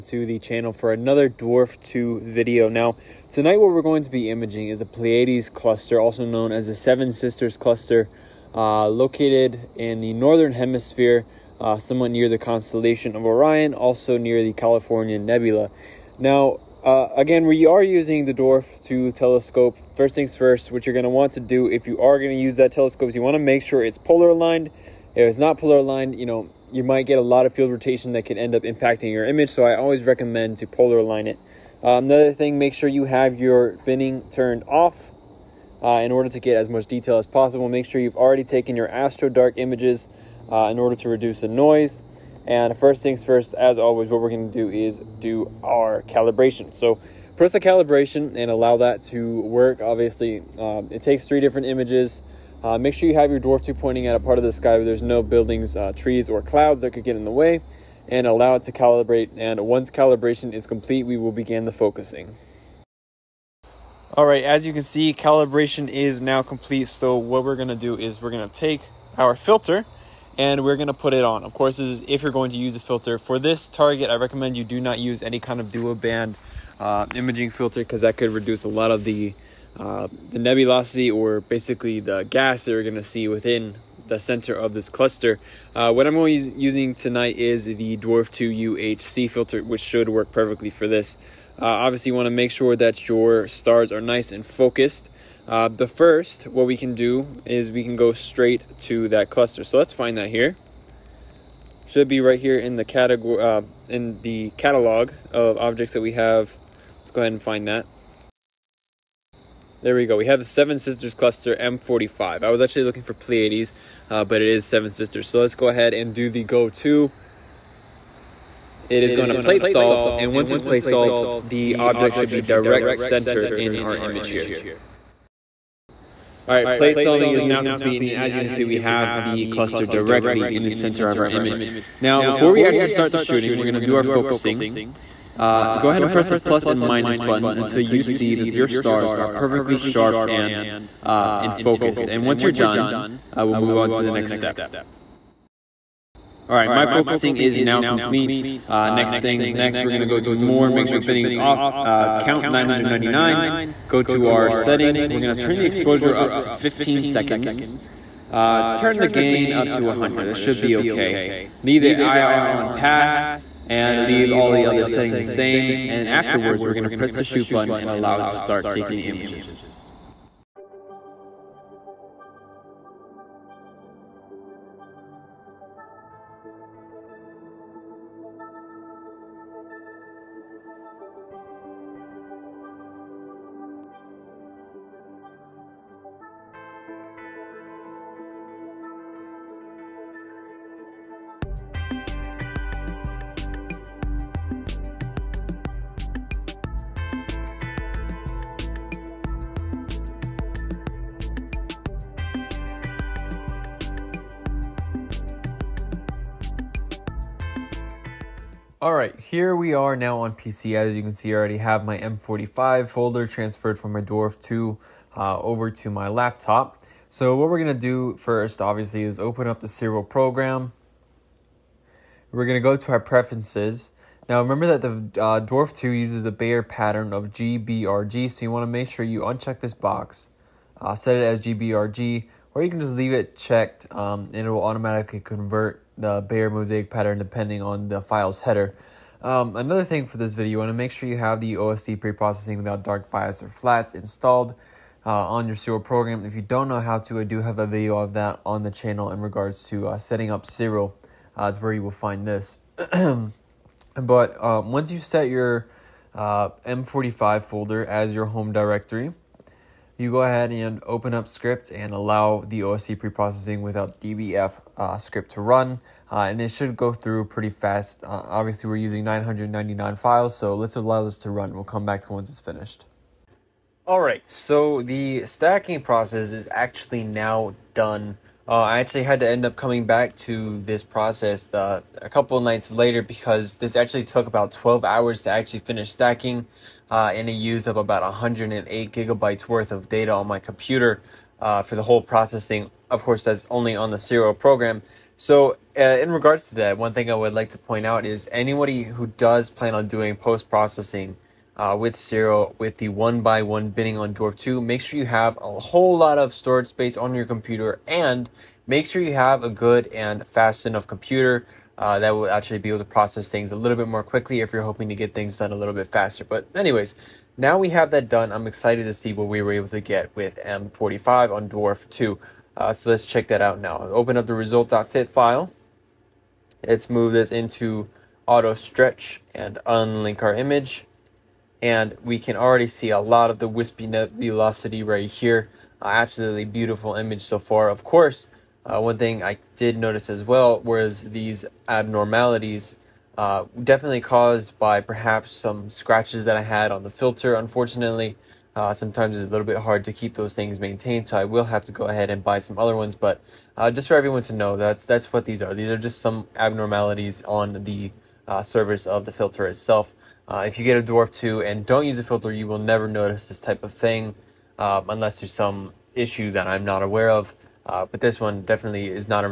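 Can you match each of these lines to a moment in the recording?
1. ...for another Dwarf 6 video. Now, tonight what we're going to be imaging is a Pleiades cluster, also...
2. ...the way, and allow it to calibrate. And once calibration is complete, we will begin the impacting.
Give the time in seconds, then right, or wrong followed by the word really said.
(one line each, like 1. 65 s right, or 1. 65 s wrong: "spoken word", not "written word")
1. 0 s wrong: "2", not "6"
2. 57 s wrong: "focusing", not "impacting".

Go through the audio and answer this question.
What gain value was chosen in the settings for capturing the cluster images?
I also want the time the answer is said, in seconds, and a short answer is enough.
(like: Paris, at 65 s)
100, at 159 s.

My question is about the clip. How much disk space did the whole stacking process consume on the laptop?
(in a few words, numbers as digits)
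108 gigabytes.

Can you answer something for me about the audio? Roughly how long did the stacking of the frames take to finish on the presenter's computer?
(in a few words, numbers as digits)
12 hours.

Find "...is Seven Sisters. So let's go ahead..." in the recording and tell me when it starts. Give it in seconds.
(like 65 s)
114 s.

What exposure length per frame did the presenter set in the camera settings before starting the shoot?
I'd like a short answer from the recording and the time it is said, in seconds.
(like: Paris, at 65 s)
15 seconds, at 156 s.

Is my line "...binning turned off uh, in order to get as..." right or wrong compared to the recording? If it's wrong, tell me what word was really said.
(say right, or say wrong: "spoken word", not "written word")
right.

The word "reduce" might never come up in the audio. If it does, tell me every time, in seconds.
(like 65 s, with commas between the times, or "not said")
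41 s, 78 s.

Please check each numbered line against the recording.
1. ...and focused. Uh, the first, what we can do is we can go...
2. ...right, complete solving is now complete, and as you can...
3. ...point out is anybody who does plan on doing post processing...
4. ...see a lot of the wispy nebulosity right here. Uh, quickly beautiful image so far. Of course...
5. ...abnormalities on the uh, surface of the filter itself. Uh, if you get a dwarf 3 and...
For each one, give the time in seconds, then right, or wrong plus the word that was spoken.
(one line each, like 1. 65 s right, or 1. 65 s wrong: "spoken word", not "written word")
1. 94 s right
2. 126 s wrong: "plate", not "complete"
3. 297 s right
4. 332 s wrong: "absolutely", not "quickly"
5. 356 s wrong: "2", not "3".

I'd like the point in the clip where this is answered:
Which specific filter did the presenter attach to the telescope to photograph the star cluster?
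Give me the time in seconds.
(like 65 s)
87 s.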